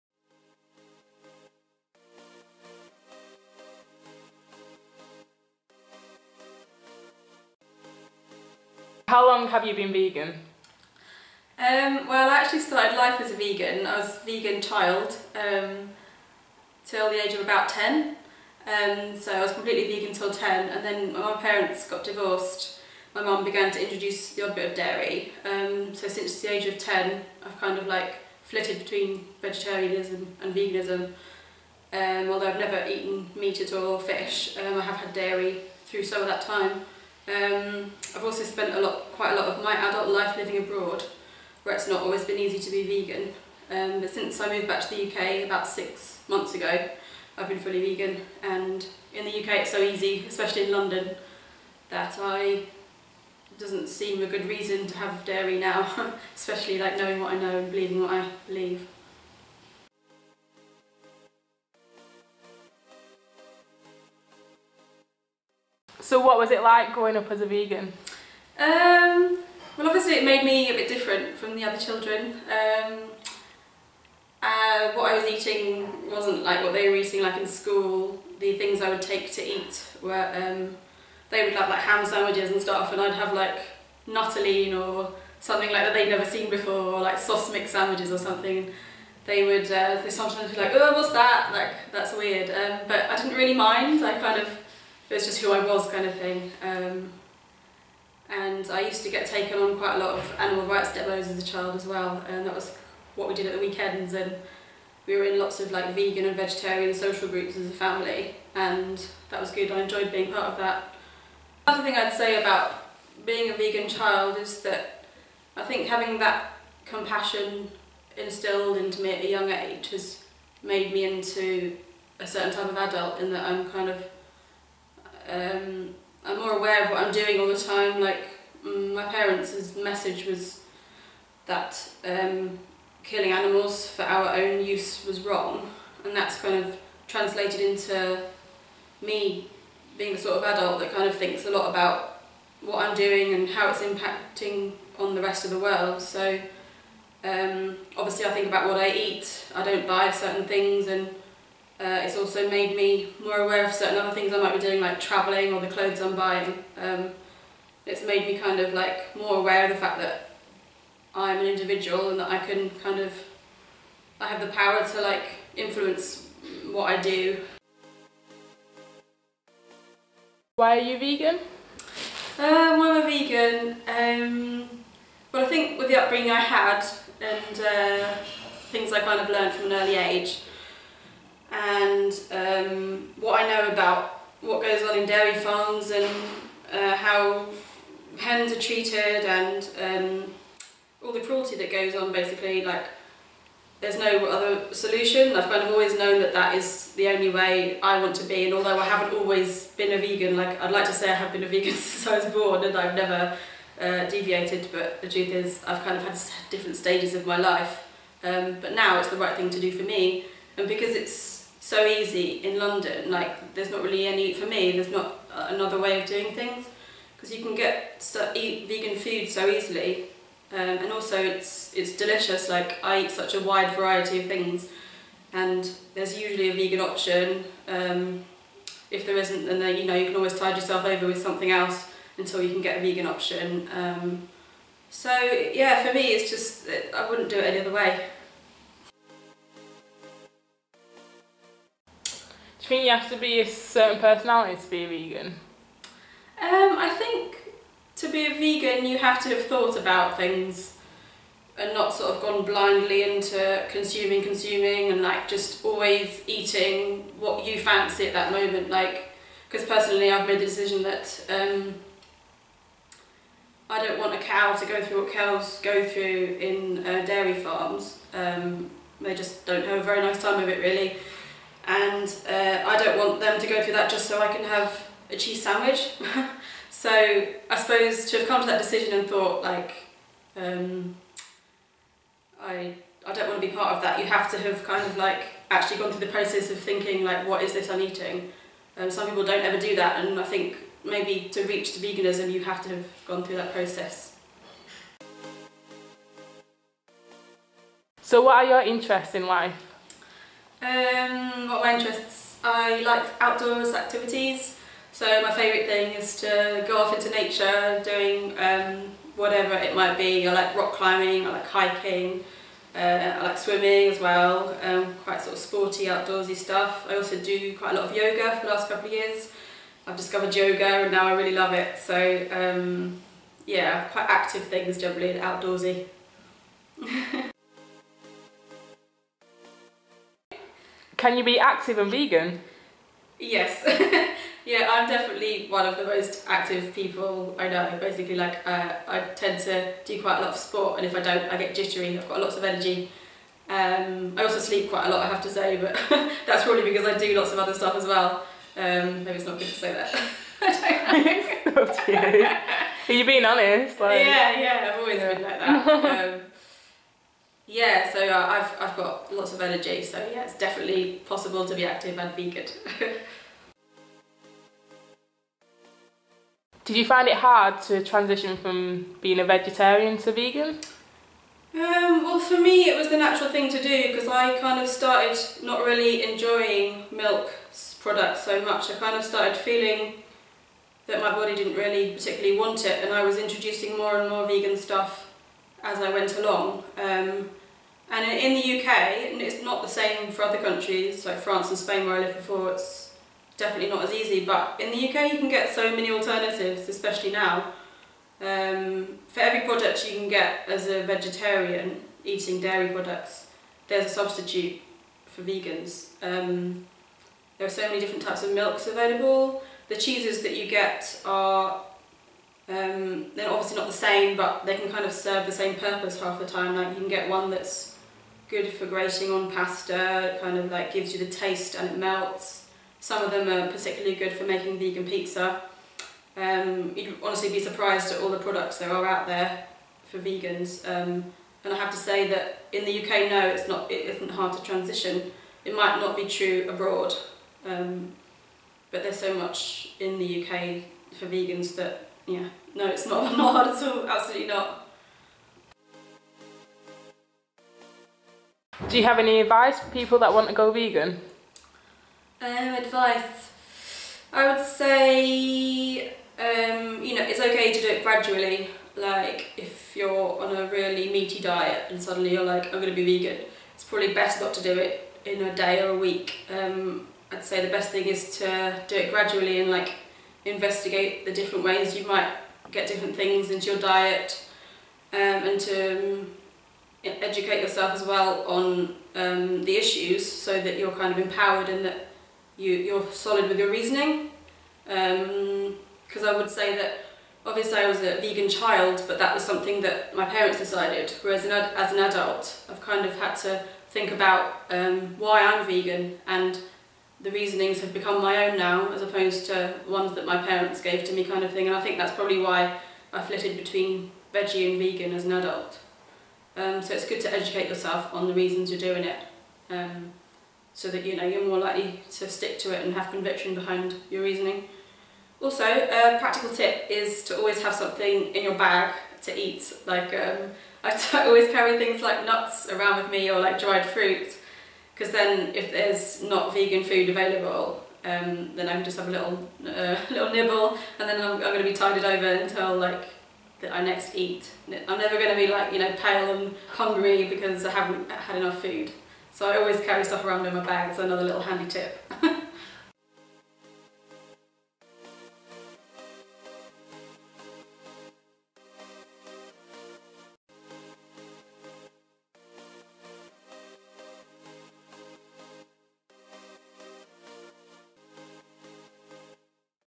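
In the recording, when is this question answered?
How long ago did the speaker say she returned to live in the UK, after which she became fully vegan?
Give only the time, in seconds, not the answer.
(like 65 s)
45 s.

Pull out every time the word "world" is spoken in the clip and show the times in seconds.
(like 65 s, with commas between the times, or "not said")
145 s.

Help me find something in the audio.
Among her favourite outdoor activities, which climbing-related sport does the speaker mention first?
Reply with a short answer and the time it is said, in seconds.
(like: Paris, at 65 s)
Rock climbing, at 310 s.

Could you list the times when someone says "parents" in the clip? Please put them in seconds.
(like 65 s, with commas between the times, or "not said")
21 s, 129 s, 490 s, 500 s.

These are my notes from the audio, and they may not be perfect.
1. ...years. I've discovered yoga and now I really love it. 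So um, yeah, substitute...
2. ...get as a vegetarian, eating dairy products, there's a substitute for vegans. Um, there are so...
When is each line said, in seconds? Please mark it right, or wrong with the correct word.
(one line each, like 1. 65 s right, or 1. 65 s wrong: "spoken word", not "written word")
1. 318 s wrong: "quite", not "substitute"
2. 400 s right.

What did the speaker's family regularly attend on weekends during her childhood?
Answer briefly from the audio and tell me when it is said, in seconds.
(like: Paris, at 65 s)
Animal rights demos, at 100 s.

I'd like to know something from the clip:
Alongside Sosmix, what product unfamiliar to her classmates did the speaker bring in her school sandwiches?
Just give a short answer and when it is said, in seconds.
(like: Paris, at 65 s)
Nuttolene, at 84 s.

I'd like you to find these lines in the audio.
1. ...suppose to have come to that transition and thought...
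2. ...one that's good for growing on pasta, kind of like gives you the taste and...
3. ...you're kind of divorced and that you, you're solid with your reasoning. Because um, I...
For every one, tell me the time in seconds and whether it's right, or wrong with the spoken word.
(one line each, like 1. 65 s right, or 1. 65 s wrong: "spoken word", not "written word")
1. 277 s wrong: "decision", not "transition"
2. 417 s wrong: "grating", not "growing"
3. 480 s wrong: "empowered", not "divorced".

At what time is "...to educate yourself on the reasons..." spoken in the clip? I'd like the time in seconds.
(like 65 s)
507 s.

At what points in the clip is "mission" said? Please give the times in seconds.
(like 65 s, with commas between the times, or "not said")
not said.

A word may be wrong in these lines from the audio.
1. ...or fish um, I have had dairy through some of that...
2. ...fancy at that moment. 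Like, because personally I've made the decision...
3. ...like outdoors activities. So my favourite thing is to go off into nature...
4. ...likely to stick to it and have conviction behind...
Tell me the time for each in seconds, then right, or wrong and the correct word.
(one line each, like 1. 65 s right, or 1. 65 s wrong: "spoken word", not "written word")
1. 33 s right
2. 257 s right
3. 302 s right
4. 511 s right.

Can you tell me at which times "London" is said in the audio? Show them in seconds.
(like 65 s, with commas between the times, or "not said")
50 s, 212 s.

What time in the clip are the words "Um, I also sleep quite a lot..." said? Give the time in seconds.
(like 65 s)
343 s.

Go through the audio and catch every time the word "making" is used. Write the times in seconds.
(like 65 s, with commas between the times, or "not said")
424 s.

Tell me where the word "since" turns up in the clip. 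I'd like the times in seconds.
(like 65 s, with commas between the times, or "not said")
26 s, 44 s, 201 s.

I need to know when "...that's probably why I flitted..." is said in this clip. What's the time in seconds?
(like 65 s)
501 s.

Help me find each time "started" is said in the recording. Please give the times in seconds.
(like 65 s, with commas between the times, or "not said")
12 s, 374 s, 379 s.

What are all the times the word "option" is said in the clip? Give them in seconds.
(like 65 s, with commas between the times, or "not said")
226 s, 233 s.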